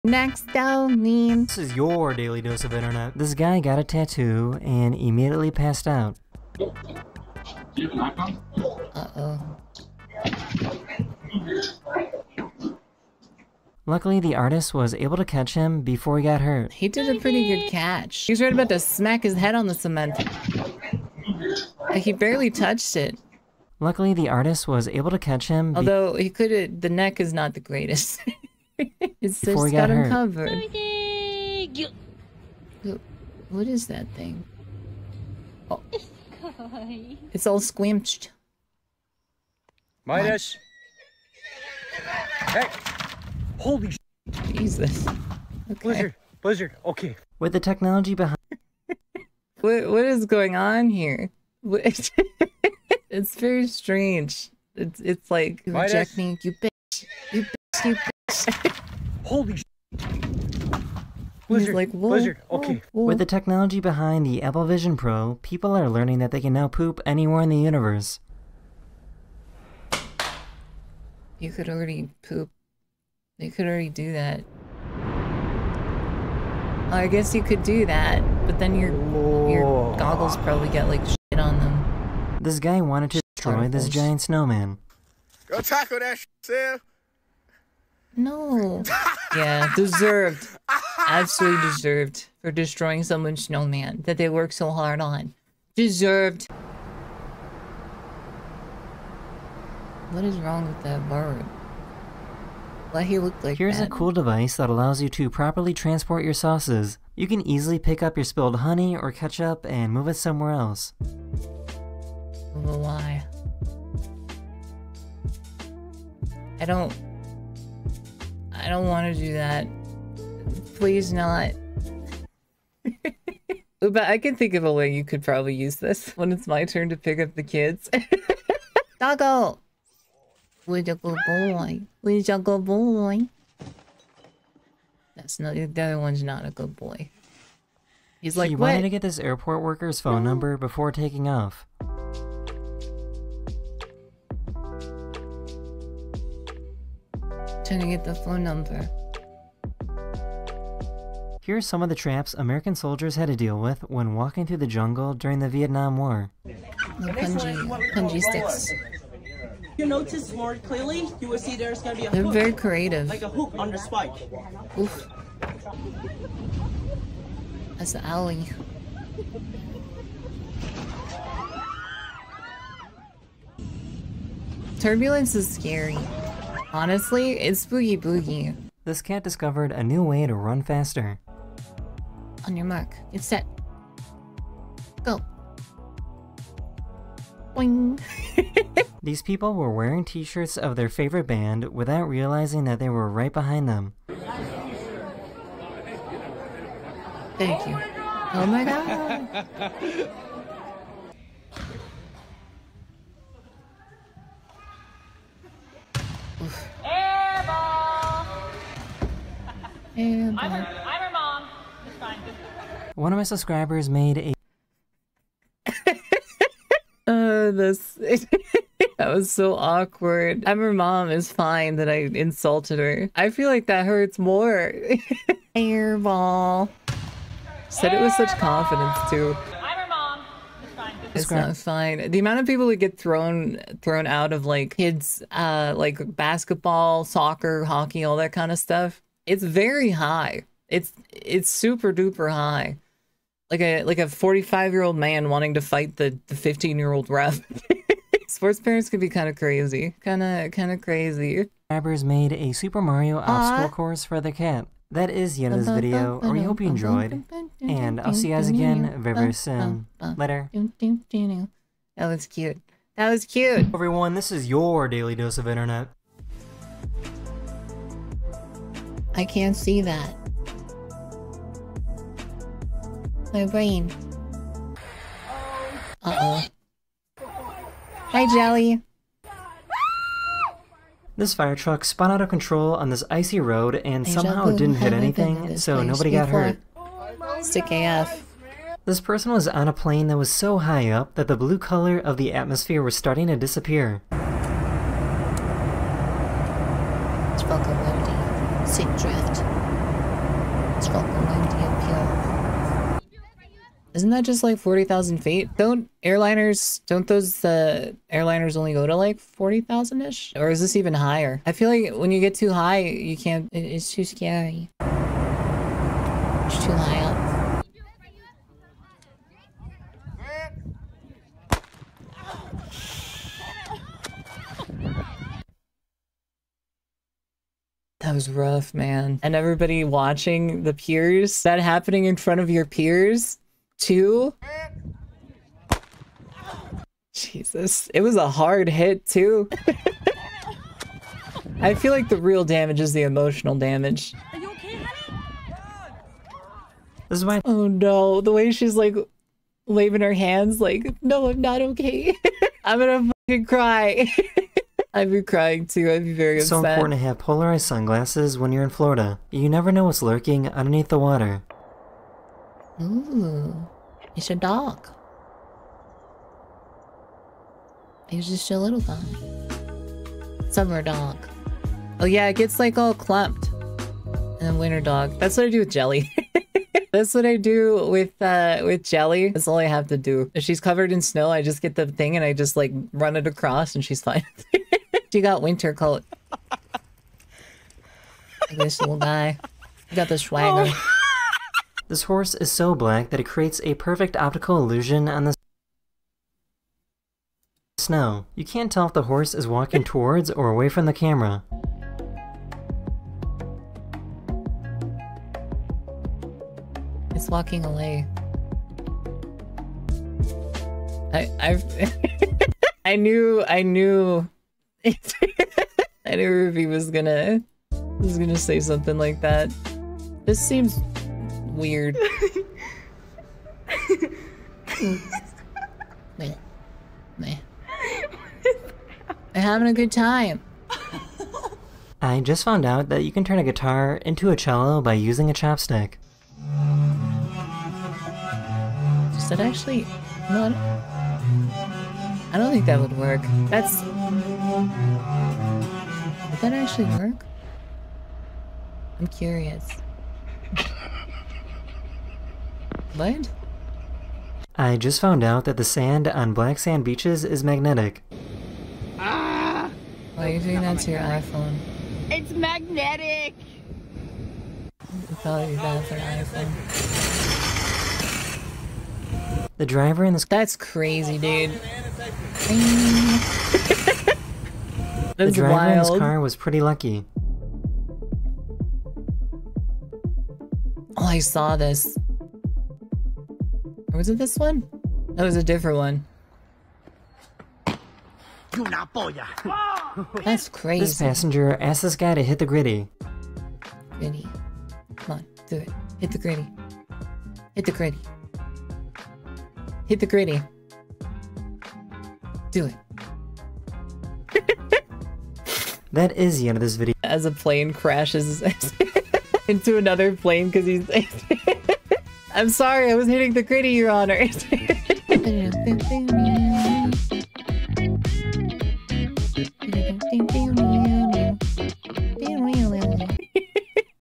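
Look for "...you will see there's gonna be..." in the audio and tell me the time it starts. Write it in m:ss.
2:41.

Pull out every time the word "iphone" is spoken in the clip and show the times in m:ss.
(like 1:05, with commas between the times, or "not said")
7:41, 7:45.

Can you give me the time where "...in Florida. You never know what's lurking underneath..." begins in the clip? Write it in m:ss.
5:58.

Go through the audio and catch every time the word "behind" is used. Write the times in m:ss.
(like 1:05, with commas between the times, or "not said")
0:48, 1:03, 3:13.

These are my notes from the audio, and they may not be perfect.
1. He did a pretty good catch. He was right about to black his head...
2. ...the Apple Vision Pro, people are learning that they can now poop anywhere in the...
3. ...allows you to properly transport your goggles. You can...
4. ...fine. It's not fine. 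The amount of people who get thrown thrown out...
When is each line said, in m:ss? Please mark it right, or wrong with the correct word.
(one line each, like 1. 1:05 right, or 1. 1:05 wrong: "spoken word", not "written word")
1. 0:16 wrong: "smack", not "black"
2. 1:04 right
3. 1:44 wrong: "sauces", not "goggles"
4. 3:50 right.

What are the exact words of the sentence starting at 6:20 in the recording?
If she's covered in snow, I just get the thing and I just like run it across and she's fine.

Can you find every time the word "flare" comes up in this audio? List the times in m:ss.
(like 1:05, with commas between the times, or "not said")
not said.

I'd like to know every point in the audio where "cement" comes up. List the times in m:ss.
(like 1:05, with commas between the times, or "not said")
0:19.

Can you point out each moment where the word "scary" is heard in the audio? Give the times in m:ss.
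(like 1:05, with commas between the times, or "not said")
2:55, 5:14.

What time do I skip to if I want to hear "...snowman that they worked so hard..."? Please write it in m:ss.
1:33.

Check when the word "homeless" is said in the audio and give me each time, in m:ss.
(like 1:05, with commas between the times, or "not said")
not said.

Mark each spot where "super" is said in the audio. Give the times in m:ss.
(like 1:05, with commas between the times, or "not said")
4:01, 4:12.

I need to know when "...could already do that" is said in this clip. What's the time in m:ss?
1:13.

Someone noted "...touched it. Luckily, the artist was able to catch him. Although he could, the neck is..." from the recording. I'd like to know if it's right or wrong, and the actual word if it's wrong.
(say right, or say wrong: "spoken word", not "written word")
right.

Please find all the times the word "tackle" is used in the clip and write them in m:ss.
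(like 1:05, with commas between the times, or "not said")
1:25.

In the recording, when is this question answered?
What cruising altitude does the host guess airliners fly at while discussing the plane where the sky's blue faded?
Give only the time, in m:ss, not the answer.
5:04.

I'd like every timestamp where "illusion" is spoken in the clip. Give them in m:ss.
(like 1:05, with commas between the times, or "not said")
6:34.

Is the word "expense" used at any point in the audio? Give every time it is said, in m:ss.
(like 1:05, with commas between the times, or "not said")
not said.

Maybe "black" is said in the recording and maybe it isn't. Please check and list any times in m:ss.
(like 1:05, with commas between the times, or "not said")
6:32, 7:36.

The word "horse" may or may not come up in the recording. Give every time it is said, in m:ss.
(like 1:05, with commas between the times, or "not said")
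6:32, 6:39.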